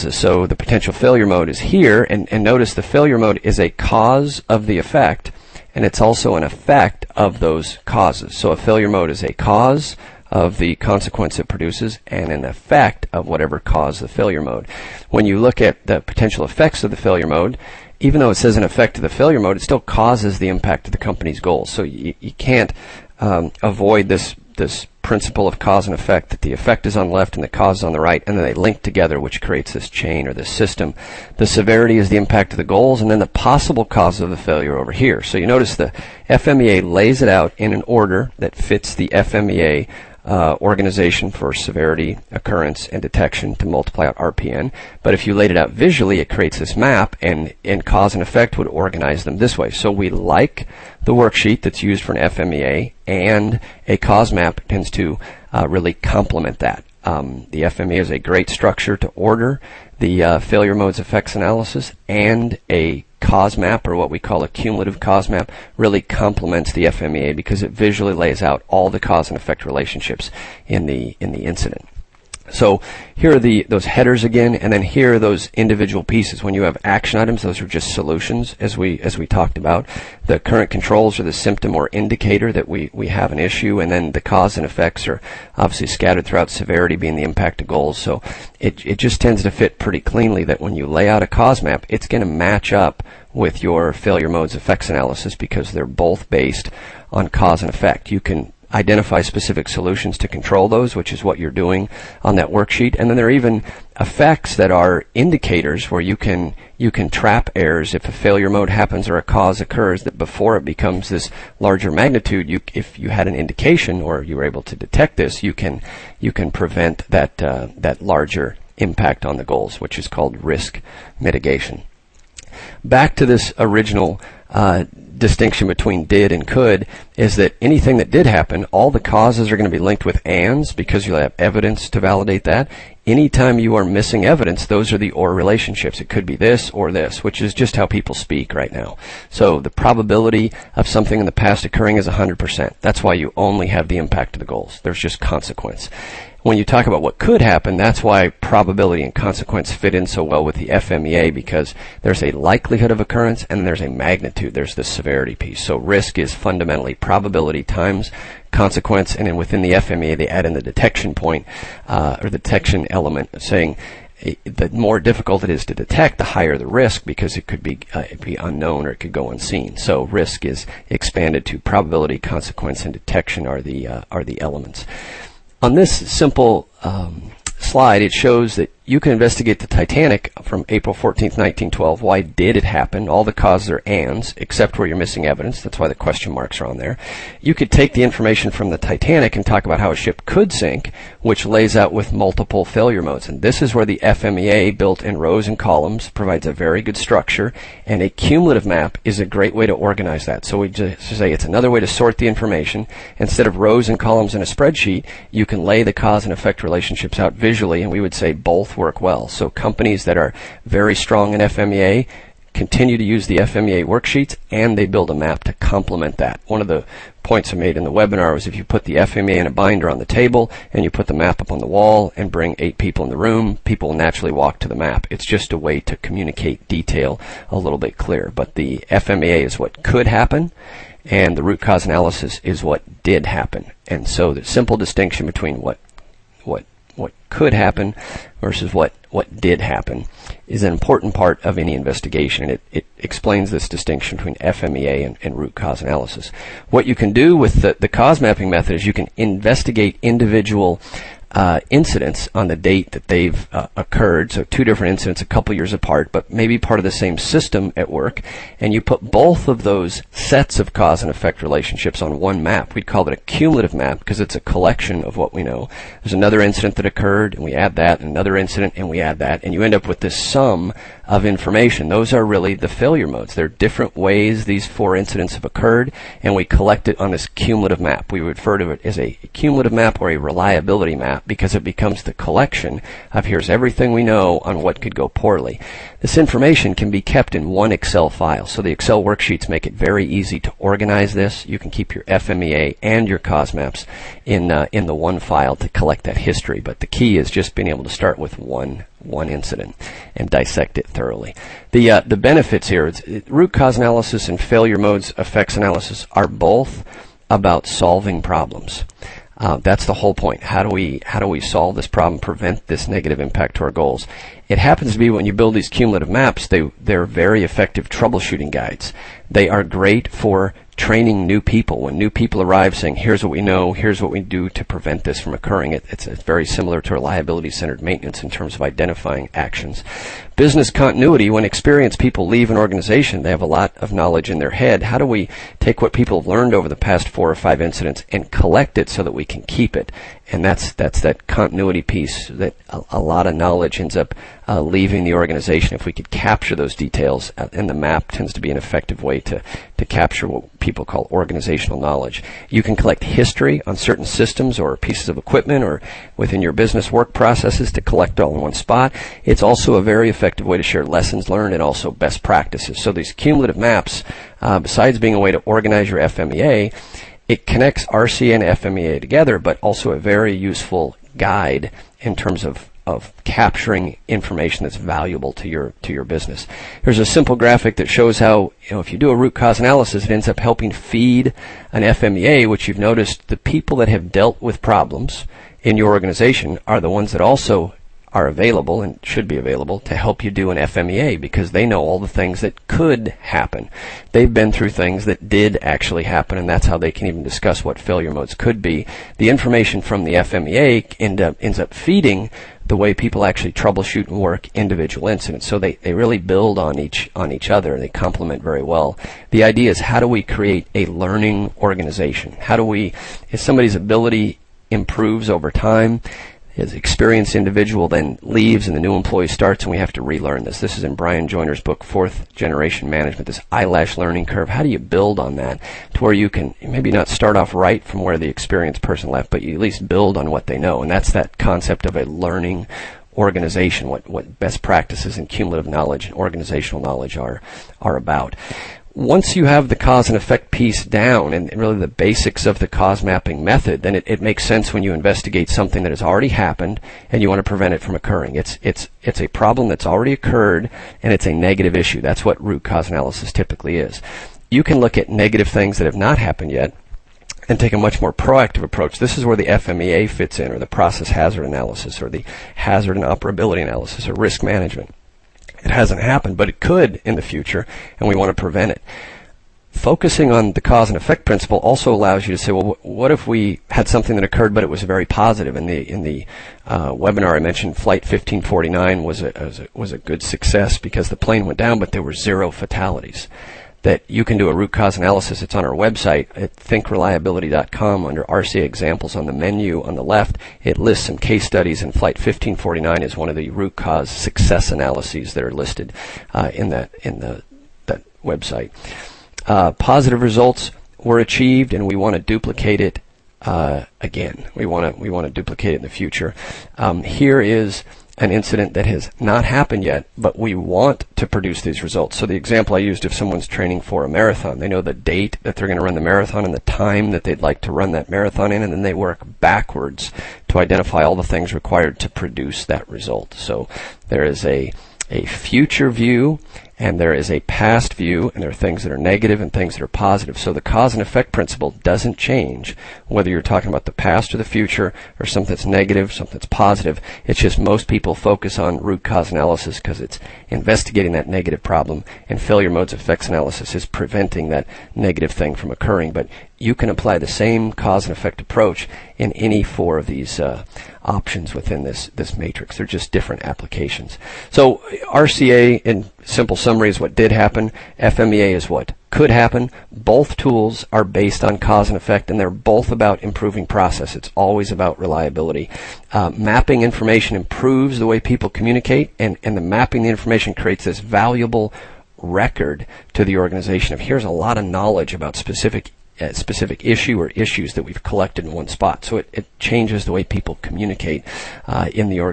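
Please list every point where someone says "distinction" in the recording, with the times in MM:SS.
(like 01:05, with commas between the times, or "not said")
02:05, 03:54, 04:03.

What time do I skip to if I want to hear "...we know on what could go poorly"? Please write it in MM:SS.
04:43.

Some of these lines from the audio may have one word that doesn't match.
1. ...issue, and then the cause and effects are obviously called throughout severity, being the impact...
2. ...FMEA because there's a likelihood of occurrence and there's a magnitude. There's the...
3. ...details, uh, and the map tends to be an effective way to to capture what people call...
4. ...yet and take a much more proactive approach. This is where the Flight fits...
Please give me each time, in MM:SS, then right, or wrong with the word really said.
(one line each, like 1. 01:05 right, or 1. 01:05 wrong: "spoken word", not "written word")
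1. 01:23 wrong: "scattered", not "called"
2. 02:30 right
3. 05:46 right
4. 07:36 wrong: "FMEA", not "Flight".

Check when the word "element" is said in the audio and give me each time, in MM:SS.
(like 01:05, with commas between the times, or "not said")
02:42, 02:54.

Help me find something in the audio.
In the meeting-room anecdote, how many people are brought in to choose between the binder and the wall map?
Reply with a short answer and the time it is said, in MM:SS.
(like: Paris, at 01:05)
8, at 03:42.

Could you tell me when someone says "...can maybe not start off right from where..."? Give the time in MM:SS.
07:06.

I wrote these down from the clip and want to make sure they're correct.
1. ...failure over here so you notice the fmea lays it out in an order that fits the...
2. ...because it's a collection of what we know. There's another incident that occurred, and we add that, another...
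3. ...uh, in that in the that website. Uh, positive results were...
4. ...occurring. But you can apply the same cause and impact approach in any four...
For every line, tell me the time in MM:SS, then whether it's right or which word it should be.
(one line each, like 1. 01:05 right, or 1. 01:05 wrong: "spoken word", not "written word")
1. 00:34 right
2. 04:24 right
3. 08:16 right
4. 09:05 wrong: "effect", not "impact".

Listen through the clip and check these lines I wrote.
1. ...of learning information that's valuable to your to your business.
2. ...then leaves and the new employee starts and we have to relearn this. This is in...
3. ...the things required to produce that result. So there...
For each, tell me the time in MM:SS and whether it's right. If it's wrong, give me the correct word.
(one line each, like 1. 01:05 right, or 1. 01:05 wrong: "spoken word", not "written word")
1. 06:12 wrong: "capturing", not "learning"
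2. 06:57 right
3. 08:41 right.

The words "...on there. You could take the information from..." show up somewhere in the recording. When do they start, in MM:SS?
03:06.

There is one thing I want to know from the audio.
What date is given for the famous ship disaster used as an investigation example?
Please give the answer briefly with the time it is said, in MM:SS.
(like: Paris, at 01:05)
April 14, 1912, at 03:00.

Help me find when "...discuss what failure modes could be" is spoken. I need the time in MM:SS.
06:37.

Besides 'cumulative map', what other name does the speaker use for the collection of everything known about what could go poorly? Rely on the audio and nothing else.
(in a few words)
reliability map.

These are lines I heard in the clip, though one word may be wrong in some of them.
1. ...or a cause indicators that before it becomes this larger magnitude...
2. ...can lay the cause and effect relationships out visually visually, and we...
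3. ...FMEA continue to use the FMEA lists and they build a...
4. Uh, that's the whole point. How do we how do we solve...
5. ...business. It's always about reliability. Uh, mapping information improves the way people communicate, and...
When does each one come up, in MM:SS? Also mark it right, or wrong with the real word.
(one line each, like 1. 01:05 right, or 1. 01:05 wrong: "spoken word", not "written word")
1. 01:49 wrong: "occurs", not "indicators"
2. 03:25 right
3. 03:31 wrong: "worksheets", not "lists"
4. 05:09 right
5. 09:23 wrong: "process", not "business".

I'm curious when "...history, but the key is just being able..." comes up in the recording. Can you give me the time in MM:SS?
04:56.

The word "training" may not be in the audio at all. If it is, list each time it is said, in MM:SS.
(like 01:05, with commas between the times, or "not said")
05:20, 08:33.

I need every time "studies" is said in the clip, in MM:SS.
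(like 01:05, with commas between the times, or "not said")
08:11.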